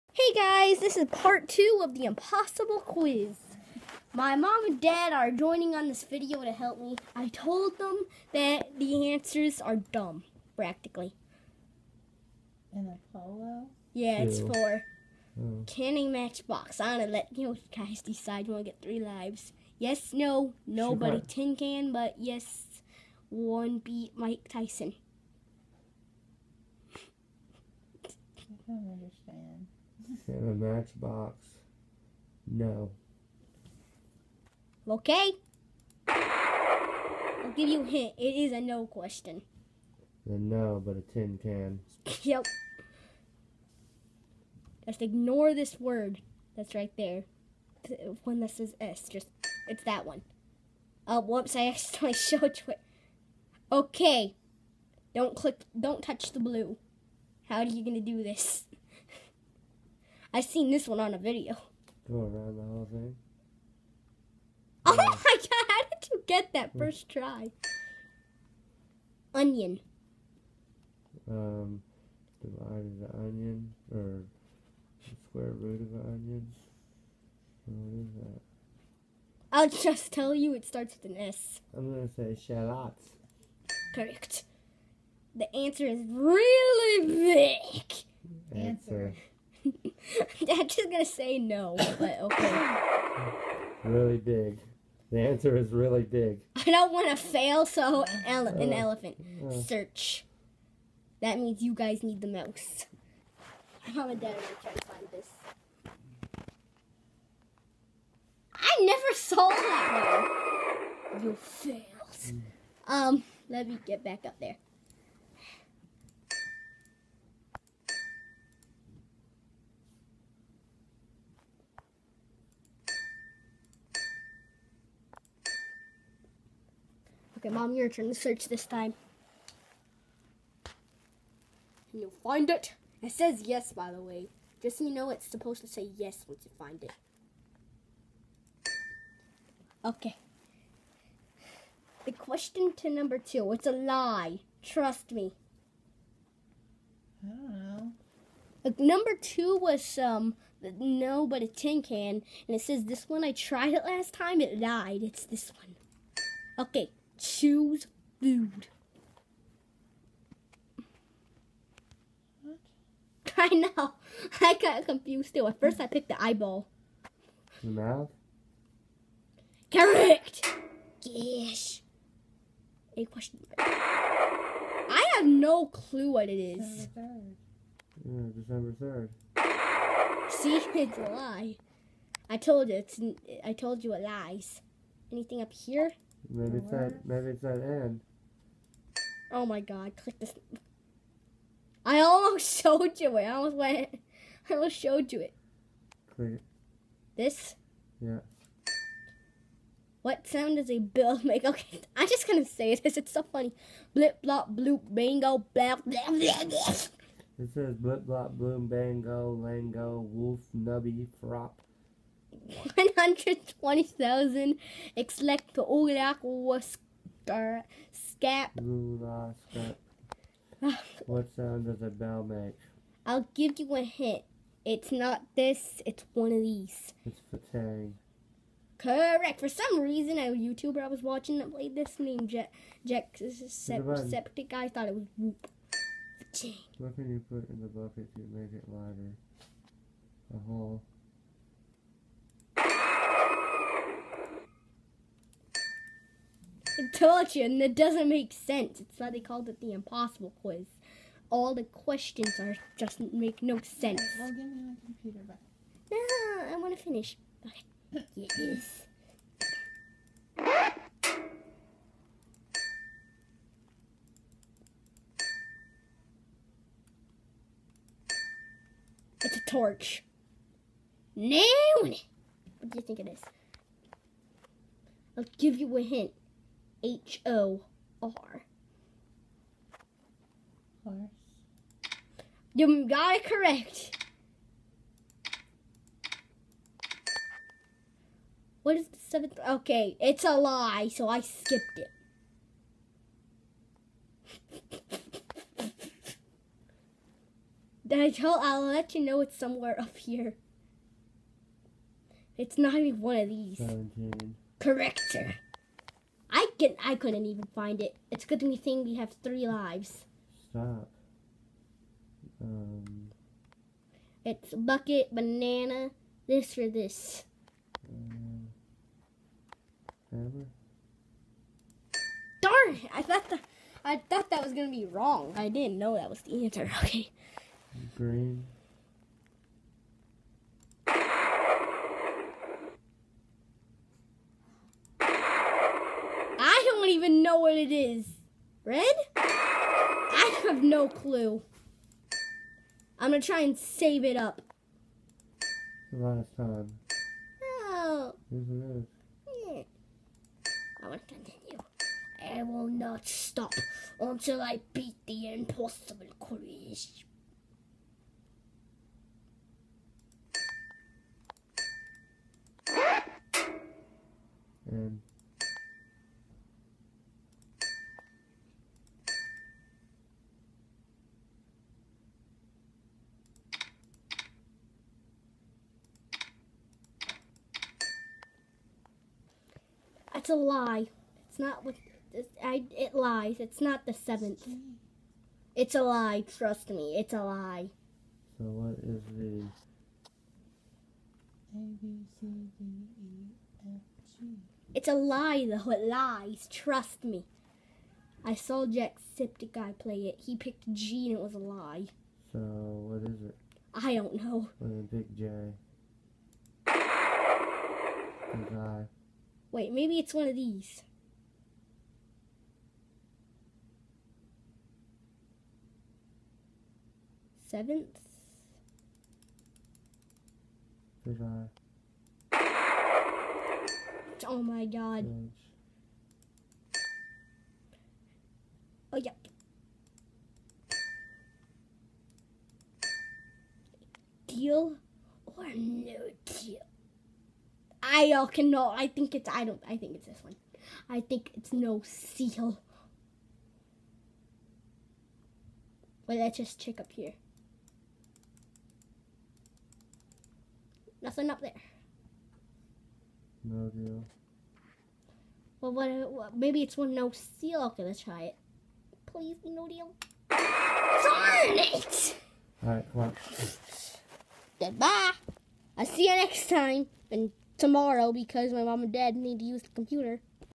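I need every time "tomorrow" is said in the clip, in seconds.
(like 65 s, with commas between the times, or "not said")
467 s.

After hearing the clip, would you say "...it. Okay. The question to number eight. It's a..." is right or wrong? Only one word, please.
wrong.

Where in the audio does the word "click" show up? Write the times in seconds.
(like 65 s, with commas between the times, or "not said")
55 s, 189 s, 196 s.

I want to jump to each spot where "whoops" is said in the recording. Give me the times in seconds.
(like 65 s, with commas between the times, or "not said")
51 s, 235 s.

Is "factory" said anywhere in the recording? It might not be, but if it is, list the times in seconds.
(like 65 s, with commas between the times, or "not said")
not said.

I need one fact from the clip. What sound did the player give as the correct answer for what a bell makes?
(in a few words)
fatang.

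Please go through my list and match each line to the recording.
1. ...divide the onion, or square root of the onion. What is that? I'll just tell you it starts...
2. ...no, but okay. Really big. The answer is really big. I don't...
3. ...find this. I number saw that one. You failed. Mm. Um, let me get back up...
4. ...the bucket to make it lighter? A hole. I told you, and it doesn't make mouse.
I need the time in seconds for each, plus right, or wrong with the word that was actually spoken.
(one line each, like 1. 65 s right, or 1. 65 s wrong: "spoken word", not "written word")
1. 72 s right
2. 91 s right
3. 104 s wrong: "never", not "number"
4. 237 s wrong: "sense", not "mouse".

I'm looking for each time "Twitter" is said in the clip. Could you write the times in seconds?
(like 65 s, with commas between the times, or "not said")
not said.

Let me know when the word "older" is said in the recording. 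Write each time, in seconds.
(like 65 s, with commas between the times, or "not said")
not said.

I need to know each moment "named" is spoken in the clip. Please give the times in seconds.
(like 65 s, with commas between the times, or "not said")
231 s.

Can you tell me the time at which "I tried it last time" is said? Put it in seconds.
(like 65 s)
153 s.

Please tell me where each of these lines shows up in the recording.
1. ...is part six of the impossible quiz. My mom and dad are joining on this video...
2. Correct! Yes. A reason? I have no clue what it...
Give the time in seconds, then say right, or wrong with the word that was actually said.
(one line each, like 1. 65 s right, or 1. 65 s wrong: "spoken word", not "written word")
1. 0 s wrong: "two", not "six"
2. 169 s wrong: "question", not "reason".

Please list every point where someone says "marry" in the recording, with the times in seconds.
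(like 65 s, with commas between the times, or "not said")
not said.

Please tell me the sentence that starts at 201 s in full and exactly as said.
Okay, I'm just gonna say this.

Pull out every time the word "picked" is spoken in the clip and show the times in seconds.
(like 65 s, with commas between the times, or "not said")
165 s, 400 s.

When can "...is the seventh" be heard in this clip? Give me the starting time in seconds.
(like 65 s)
288 s.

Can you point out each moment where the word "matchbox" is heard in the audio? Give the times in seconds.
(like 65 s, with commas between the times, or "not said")
16 s, 30 s.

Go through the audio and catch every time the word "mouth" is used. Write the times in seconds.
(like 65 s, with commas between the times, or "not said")
167 s.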